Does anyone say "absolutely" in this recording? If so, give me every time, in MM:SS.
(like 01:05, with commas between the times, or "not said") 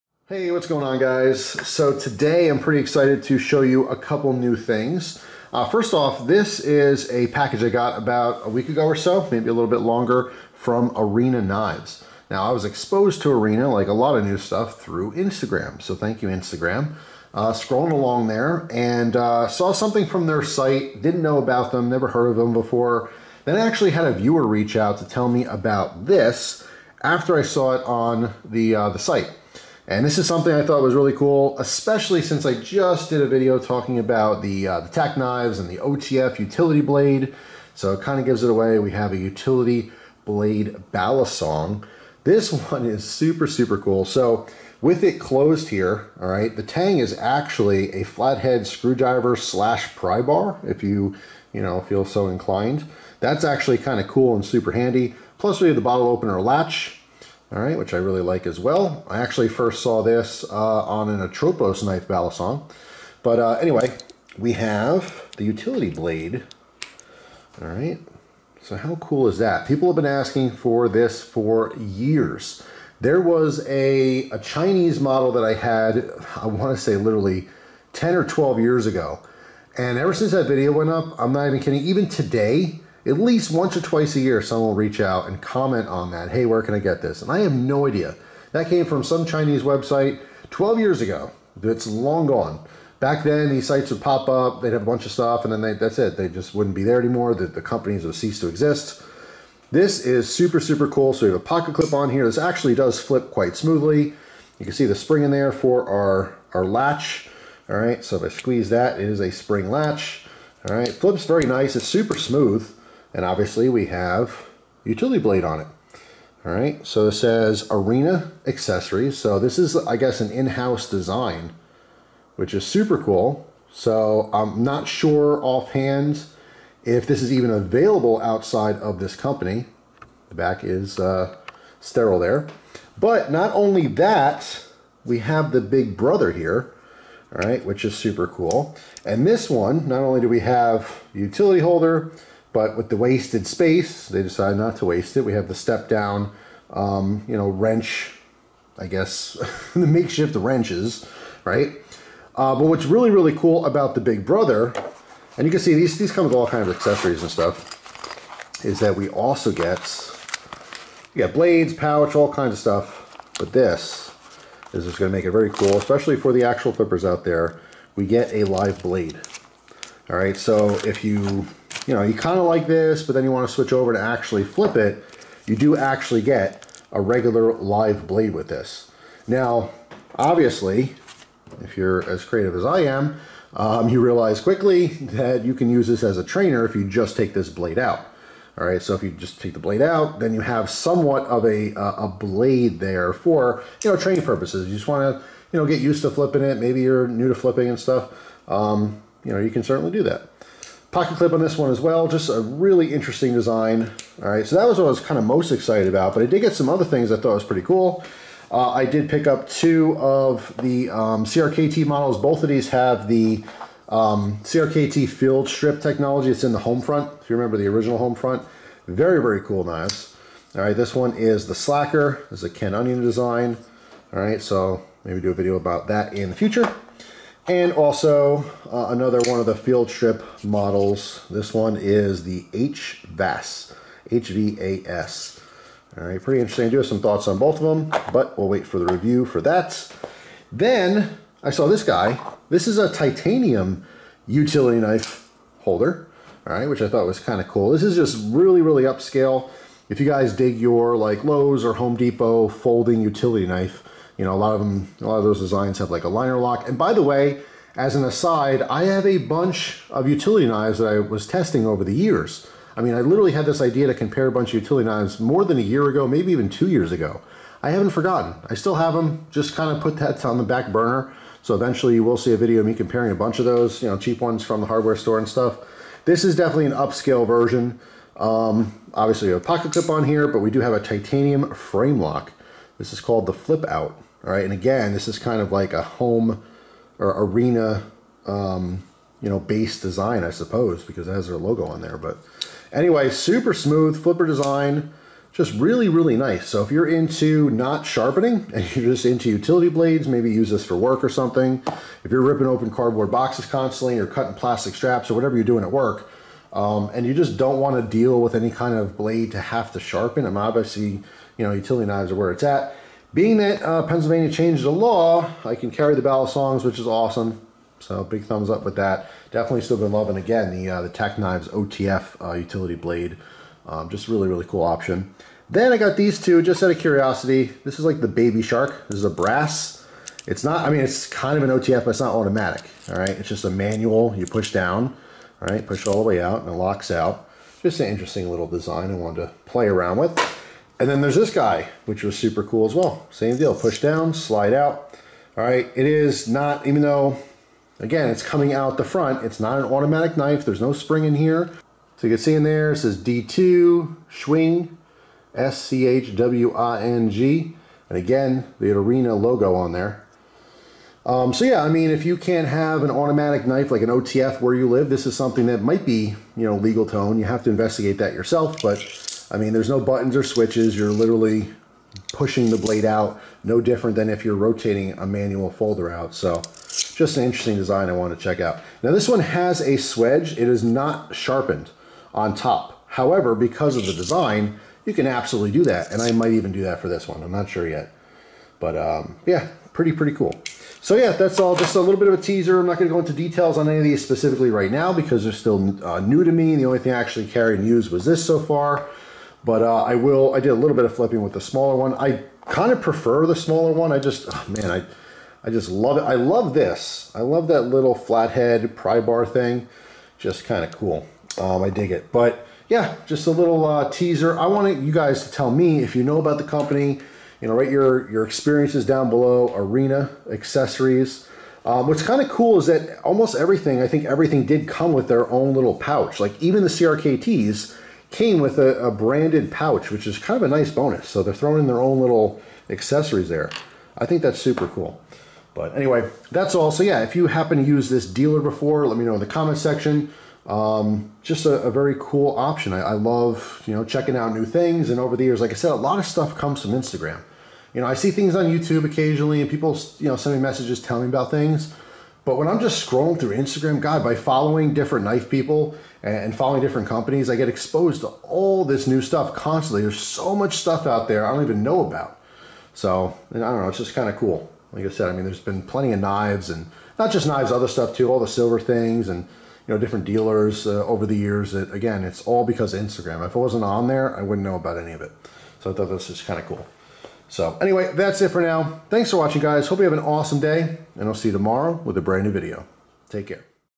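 06:25.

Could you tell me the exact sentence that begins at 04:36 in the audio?
This is definitely an upscale version.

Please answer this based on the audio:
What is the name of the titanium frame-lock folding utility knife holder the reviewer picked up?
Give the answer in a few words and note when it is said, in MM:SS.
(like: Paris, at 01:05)
Flip Out, at 04:43.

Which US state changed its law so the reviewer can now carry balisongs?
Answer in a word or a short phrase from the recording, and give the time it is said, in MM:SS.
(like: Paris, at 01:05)
Pennsylvania, at 05:13.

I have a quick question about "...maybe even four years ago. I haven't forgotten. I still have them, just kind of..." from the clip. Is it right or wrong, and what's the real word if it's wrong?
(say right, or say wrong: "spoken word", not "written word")
wrong: "two", not "four".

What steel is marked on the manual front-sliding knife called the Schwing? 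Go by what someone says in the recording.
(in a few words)
D2.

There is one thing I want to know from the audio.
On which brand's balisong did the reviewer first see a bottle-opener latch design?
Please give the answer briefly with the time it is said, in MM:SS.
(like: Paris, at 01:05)
Atropos, at 01:01.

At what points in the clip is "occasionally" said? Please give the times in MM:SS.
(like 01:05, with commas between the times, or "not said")
07:28.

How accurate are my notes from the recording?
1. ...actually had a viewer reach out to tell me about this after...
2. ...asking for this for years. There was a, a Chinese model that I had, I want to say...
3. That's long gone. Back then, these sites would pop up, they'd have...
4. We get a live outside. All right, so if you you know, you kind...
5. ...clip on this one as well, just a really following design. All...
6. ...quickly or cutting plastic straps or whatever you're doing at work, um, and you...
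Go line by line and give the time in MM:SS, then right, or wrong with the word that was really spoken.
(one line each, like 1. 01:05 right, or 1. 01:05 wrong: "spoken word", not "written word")
1. 00:23 right
2. 01:10 right
3. 01:31 right
4. 02:47 wrong: "blade", not "outside"
5. 03:21 wrong: "interesting", not "following"
6. 05:03 wrong: "constantly", not "quickly".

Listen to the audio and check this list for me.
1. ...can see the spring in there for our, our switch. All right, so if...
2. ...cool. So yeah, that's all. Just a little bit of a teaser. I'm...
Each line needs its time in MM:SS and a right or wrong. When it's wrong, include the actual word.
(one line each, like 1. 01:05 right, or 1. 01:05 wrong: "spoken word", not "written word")
1. 01:44 wrong: "latch", not "switch"
2. 06:30 right.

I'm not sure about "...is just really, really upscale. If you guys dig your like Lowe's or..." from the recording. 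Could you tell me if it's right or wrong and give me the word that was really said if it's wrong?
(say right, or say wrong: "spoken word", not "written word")
right.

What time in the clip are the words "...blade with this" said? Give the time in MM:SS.
02:58.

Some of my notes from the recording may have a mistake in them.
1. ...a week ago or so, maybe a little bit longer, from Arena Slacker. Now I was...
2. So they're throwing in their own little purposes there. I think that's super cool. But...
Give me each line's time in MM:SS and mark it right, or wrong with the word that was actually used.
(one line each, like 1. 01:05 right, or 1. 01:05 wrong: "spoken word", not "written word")
1. 00:08 wrong: "Knives", not "Slacker"
2. 07:11 wrong: "accessories", not "purposes".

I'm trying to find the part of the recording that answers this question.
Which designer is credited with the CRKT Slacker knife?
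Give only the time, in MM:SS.
03:42.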